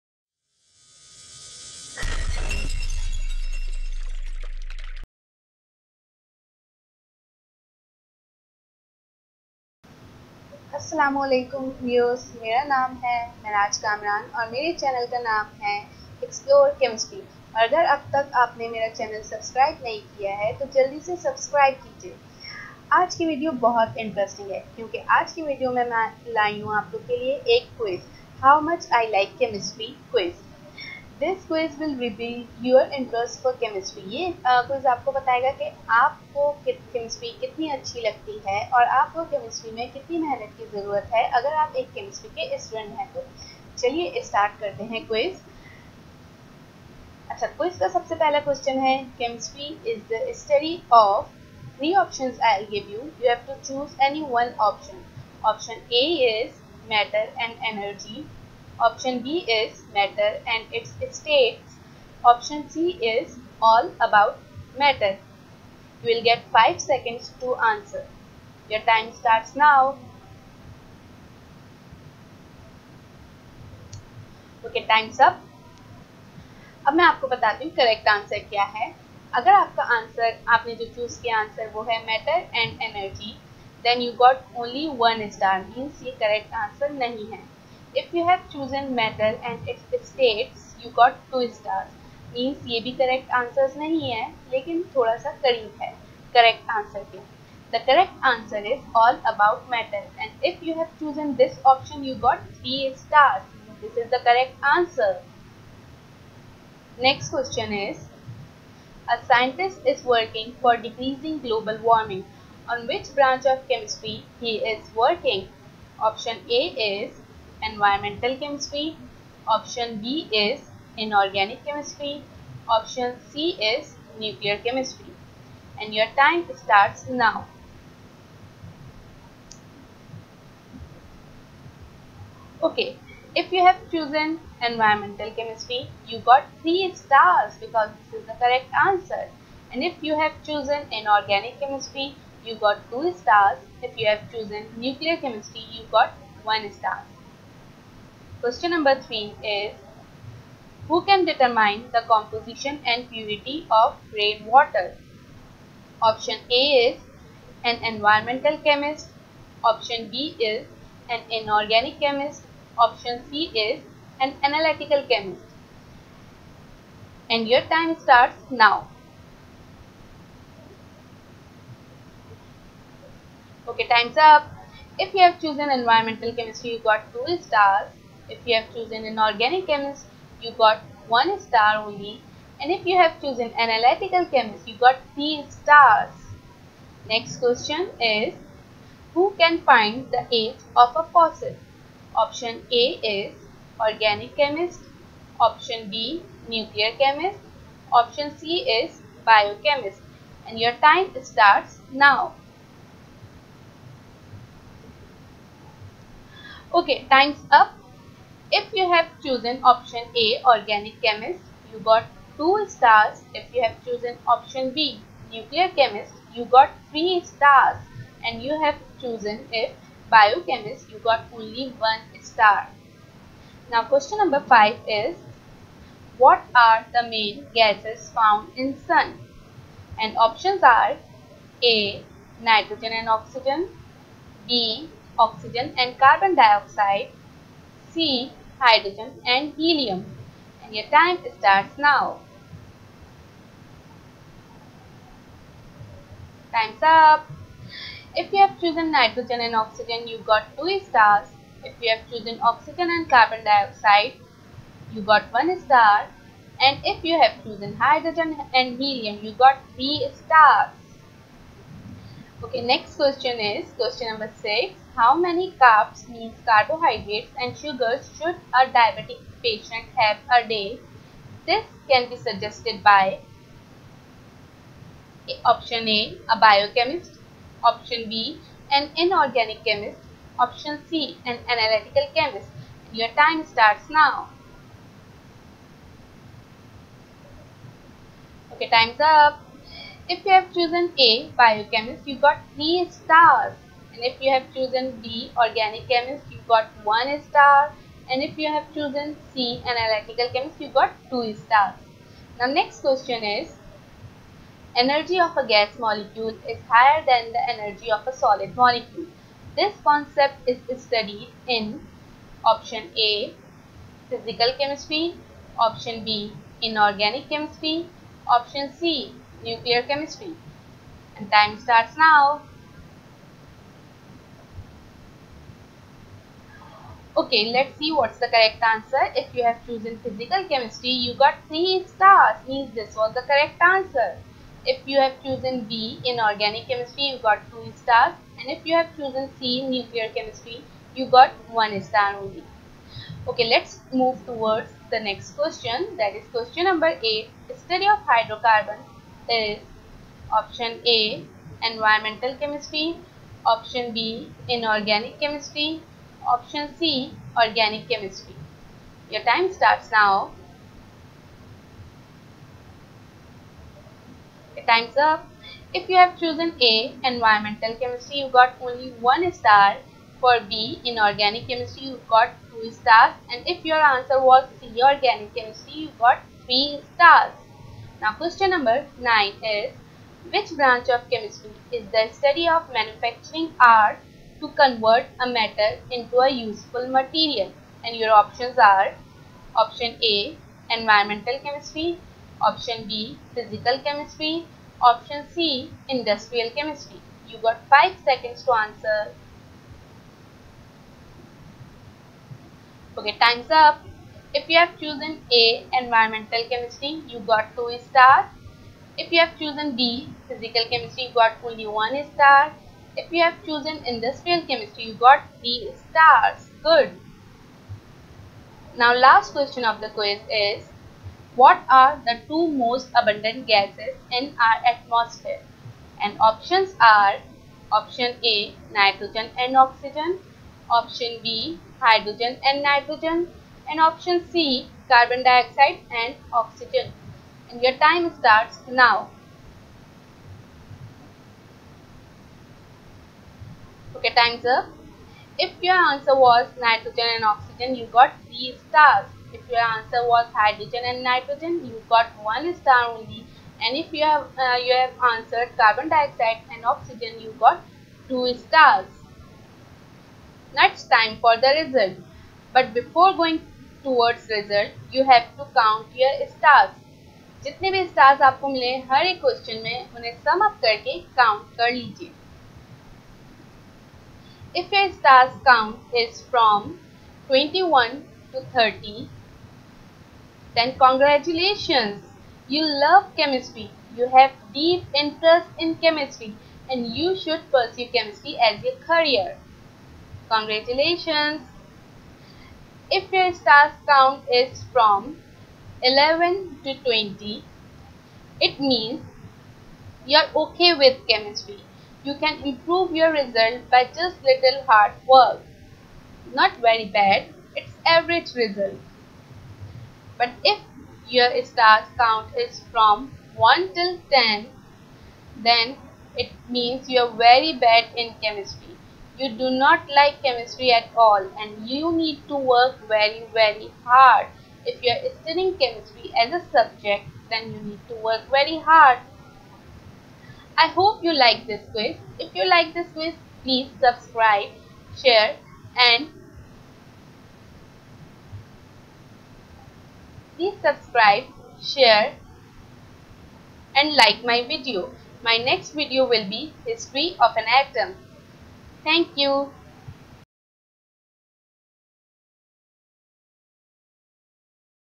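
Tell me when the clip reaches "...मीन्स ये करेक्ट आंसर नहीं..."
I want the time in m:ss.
1:25.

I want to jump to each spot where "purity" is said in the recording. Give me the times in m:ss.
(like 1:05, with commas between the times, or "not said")
2:33.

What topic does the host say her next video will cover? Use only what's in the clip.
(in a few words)
History of an atom.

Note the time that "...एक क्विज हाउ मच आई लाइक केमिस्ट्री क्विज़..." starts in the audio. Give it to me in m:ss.
0:27.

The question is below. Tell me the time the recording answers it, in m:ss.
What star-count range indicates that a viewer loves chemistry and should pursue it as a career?
7:57.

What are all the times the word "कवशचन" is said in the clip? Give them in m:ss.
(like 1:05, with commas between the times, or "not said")
0:48, 7:49.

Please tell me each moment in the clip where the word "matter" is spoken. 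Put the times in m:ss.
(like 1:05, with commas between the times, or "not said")
0:59, 1:04, 1:28, 1:39.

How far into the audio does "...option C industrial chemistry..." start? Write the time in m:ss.
6:34.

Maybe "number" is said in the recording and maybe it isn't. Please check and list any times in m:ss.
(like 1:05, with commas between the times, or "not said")
2:28, 3:44, 4:24, 5:46, 6:18.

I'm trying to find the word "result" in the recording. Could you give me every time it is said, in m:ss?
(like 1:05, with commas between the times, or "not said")
7:41, 8:23, 8:28.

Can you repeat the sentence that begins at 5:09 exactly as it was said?
This concept is studied in option A, physical chemistry, option B, inorganic chemistry, option C, nuclear chemistry.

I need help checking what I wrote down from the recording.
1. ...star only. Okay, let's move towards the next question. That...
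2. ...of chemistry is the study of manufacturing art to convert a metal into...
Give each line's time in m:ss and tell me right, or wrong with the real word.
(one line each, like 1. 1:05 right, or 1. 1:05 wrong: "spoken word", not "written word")
1. 5:41 right
2. 6:20 right.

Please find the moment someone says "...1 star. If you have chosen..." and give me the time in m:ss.
6:51.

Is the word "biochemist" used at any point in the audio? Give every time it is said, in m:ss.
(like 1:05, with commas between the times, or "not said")
3:19, 3:40, 4:36, 4:51.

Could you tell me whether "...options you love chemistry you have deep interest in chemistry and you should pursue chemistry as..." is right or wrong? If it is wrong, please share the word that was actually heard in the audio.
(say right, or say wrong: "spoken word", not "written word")
wrong: "congratulations", not "options".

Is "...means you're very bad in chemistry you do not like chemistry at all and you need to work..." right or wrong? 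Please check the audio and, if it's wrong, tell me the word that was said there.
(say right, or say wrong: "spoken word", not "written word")
right.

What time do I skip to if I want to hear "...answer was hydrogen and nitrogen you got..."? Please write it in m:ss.
7:29.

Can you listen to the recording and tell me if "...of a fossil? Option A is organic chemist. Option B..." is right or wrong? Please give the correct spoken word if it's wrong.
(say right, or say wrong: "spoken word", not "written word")
right.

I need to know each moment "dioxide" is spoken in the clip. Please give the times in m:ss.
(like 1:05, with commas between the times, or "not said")
3:56, 4:13, 7:15, 7:35.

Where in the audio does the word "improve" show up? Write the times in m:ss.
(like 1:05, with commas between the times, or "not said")
8:22.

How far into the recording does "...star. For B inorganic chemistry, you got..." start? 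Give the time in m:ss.
6:09.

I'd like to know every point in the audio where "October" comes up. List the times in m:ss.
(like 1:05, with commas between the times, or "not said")
not said.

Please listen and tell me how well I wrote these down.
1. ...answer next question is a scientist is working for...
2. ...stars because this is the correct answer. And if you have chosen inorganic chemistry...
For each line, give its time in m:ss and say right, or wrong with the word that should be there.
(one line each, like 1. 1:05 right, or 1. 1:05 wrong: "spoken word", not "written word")
1. 1:44 right
2. 2:16 right.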